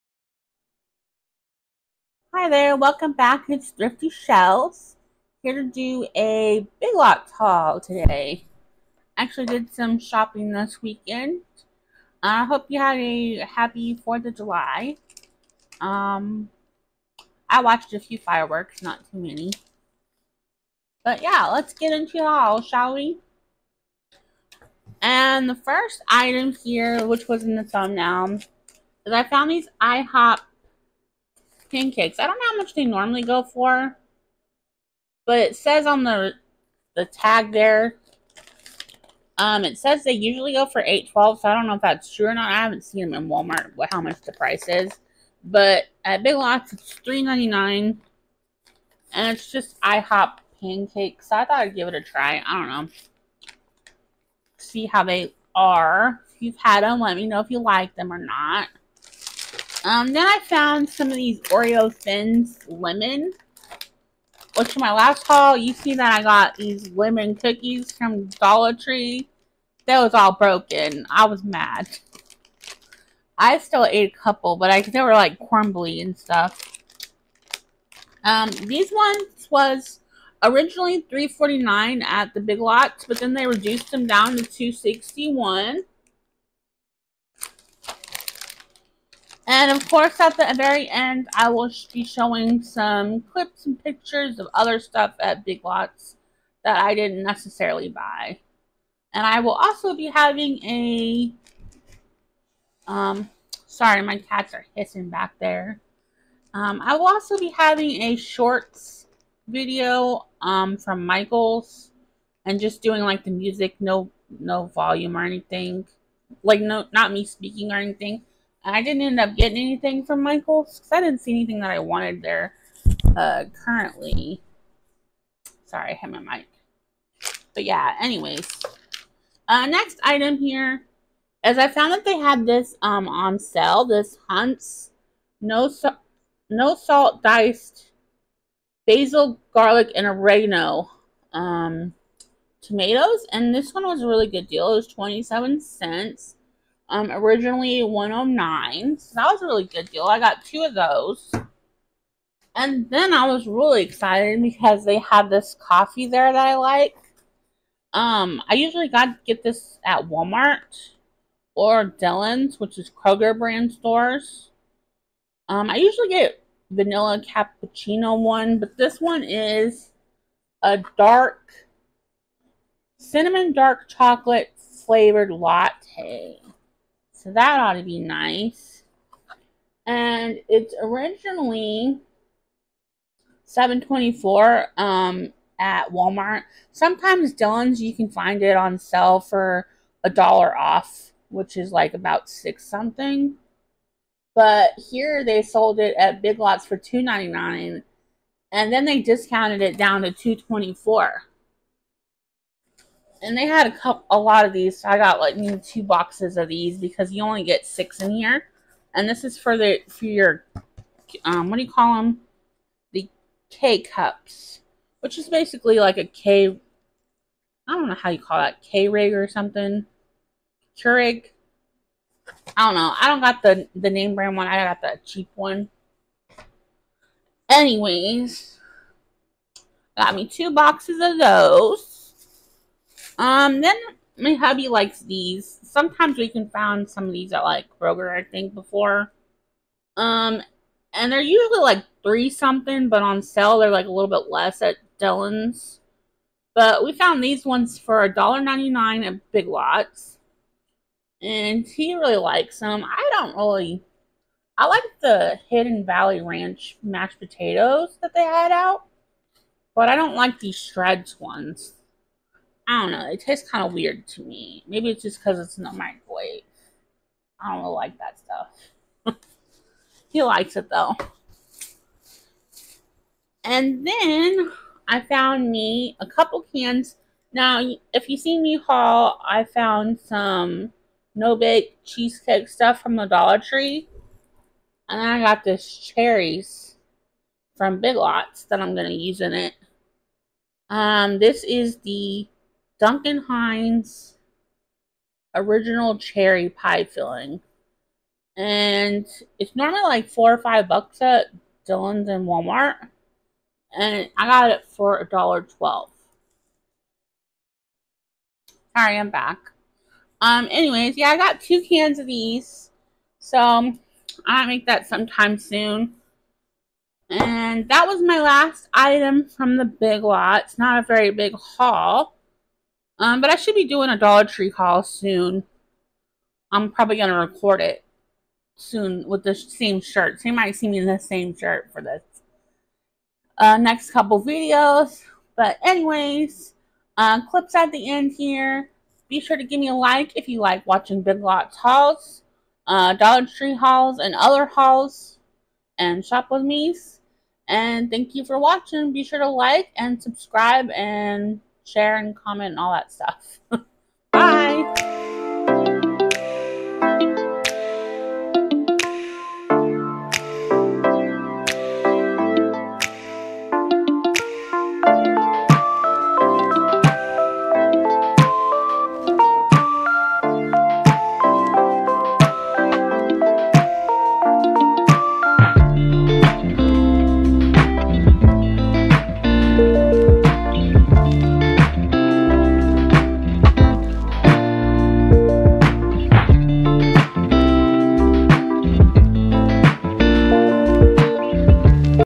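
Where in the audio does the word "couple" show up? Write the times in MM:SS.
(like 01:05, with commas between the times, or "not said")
01:14, 03:23, 04:36, 05:33.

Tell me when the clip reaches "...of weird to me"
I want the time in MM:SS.
04:23.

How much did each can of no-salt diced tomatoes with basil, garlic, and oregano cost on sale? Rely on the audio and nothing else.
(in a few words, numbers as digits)
27 cents.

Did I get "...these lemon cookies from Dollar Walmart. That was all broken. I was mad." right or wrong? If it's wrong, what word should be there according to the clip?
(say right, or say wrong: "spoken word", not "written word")
wrong: "Tree", not "Walmart".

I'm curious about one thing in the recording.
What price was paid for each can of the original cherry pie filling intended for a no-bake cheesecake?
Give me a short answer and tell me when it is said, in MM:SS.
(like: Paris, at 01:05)
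$1.12, at 05:04.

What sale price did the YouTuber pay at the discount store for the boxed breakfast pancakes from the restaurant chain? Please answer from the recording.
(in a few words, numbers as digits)
$3.99.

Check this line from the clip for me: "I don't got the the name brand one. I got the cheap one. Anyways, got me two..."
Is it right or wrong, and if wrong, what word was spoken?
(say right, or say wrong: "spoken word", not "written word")
right.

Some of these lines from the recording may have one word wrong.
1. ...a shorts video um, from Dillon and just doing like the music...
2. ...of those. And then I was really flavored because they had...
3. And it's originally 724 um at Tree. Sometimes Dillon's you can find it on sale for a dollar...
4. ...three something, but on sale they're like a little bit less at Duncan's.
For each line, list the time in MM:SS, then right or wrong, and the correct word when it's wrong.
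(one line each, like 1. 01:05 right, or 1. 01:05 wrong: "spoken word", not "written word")
1. 01:48 wrong: "Michaels", not "Dillon"
2. 02:30 wrong: "excited", not "flavored"
3. 02:59 wrong: "Walmart", not "Tree"
4. 04:02 wrong: "Dillon", not "Duncan".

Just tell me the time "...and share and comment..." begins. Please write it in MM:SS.
05:50.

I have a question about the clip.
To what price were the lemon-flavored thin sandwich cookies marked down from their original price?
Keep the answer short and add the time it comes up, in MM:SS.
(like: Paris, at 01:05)
$2.61, at 01:24.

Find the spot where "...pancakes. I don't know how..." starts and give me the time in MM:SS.
00:31.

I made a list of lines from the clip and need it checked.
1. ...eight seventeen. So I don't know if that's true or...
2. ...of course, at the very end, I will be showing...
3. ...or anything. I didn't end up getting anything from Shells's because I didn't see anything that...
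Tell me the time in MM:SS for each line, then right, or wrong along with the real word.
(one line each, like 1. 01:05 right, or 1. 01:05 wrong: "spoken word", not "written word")
1. 00:40 wrong: "twelve", not "seventeen"
2. 01:29 right
3. 01:57 wrong: "Michael", not "Shells".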